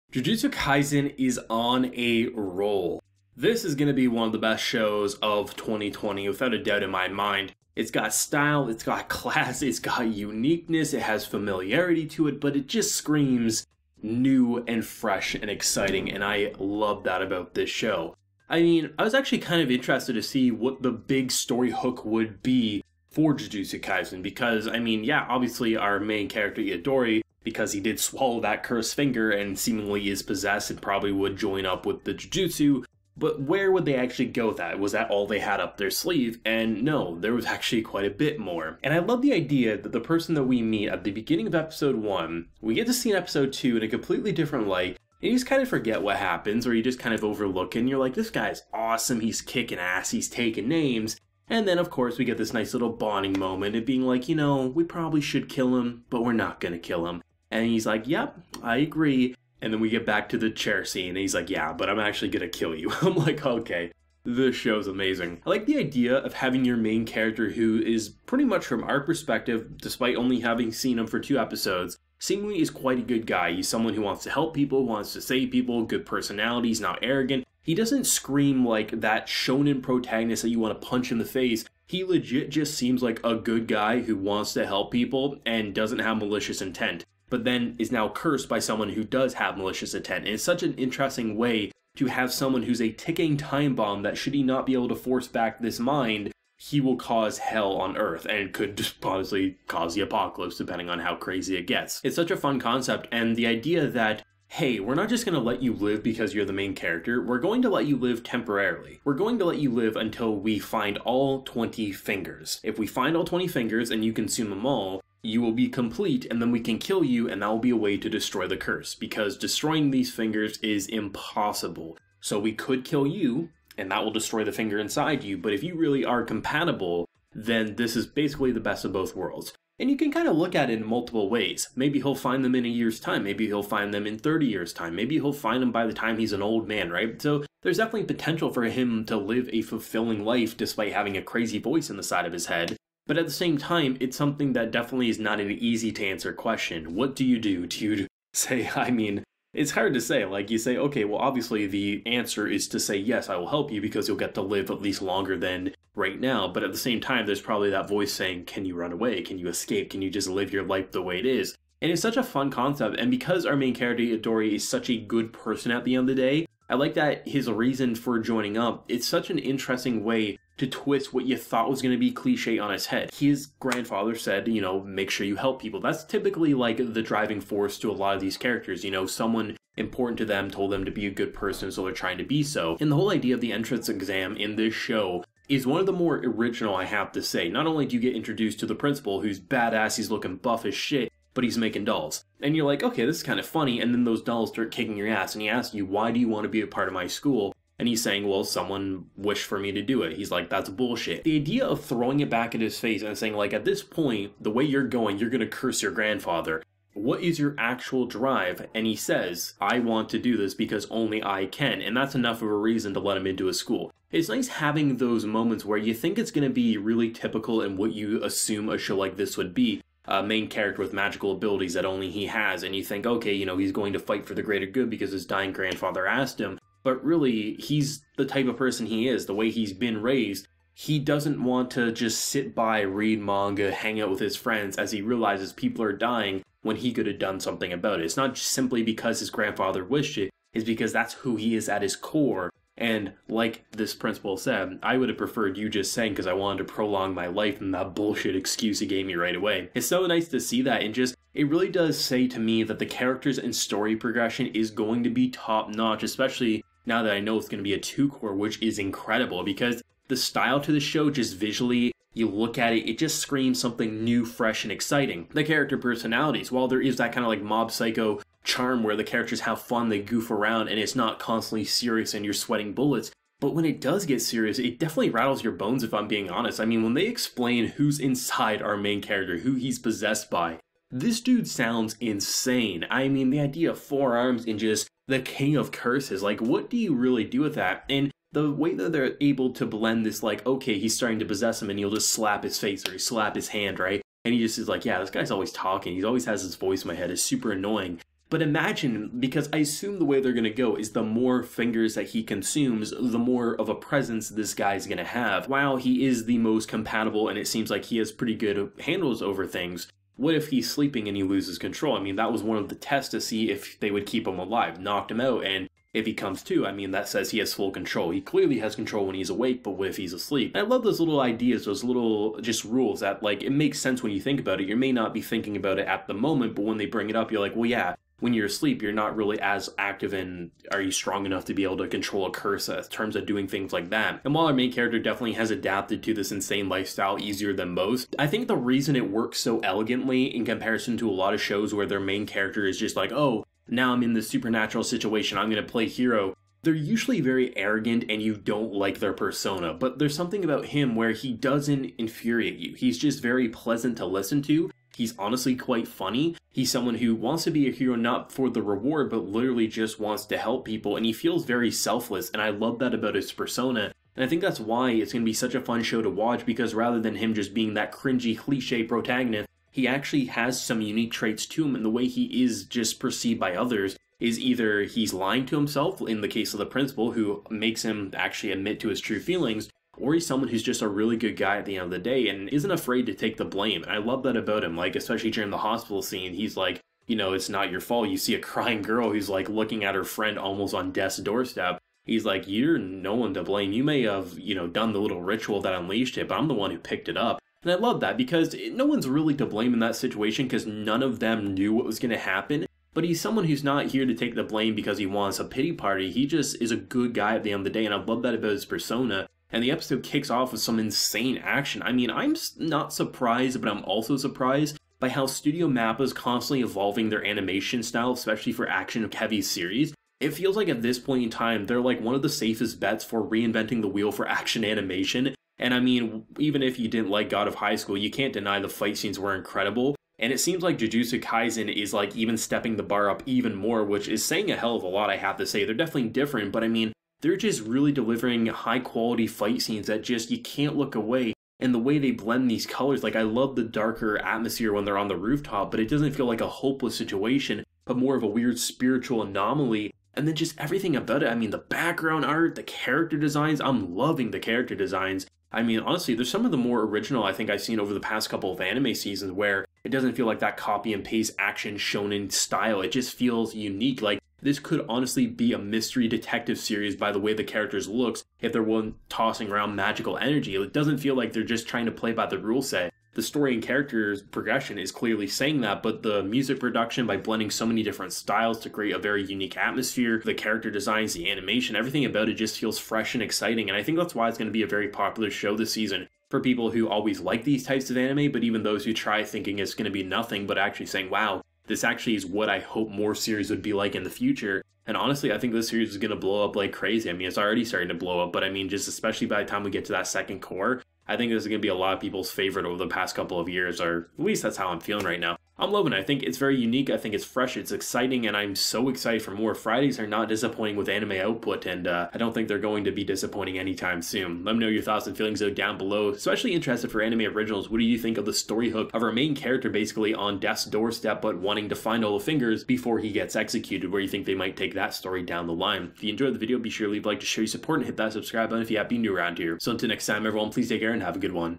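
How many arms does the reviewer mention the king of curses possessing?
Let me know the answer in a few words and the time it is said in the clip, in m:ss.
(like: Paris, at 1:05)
4, at 4:43.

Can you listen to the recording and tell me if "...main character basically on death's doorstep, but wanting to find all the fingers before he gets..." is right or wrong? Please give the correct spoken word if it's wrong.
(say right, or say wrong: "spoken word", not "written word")
right.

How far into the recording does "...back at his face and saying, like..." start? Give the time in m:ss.
3:22.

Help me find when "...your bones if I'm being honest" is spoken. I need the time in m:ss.
4:35.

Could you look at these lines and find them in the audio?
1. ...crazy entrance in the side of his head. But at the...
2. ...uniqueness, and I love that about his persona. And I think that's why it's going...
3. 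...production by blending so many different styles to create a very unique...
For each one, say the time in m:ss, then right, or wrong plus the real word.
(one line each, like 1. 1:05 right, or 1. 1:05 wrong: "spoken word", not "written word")
1. 2:21 wrong: "voice", not "entrance"
2. 6:01 wrong: "selfless", not "uniqueness"
3. 7:56 right.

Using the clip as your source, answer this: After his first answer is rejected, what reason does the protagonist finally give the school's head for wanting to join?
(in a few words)
Only I can.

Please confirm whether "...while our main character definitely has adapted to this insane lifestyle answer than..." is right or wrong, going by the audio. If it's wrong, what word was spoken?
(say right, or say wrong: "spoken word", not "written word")
wrong: "easier", not "answer".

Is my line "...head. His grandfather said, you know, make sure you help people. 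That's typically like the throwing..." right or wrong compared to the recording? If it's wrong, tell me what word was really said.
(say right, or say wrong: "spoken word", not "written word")
wrong: "driving", not "throwing".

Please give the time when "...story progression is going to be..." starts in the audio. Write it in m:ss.
4:13.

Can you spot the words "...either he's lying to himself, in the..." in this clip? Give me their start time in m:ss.
6:14.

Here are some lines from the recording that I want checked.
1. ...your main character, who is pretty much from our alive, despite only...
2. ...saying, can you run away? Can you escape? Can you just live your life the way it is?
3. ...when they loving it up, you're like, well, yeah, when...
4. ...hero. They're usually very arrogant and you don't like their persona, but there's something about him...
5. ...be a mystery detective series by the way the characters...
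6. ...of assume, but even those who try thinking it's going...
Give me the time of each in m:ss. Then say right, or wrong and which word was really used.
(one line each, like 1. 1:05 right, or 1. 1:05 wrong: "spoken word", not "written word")
1. 1:06 wrong: "perspective", not "alive"
2. 2:38 right
3. 5:26 wrong: "bring", not "loving"
4. 5:45 right
5. 7:45 right
6. 8:07 wrong: "anime", not "assume".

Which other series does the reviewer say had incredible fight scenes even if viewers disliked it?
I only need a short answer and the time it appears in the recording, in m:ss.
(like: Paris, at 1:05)
God of High School, at 7:07.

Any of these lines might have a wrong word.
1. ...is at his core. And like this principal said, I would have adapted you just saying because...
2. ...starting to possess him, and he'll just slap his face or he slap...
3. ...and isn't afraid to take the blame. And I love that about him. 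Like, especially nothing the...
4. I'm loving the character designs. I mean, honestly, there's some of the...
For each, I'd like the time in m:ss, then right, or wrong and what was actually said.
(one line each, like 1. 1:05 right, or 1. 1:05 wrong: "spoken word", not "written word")
1. 4:01 wrong: "preferred", not "adapted"
2. 4:50 right
3. 6:22 wrong: "during", not "nothing"
4. 7:33 right.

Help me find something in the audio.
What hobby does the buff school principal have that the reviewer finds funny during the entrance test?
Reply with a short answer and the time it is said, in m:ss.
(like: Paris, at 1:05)
Making dolls, at 3:11.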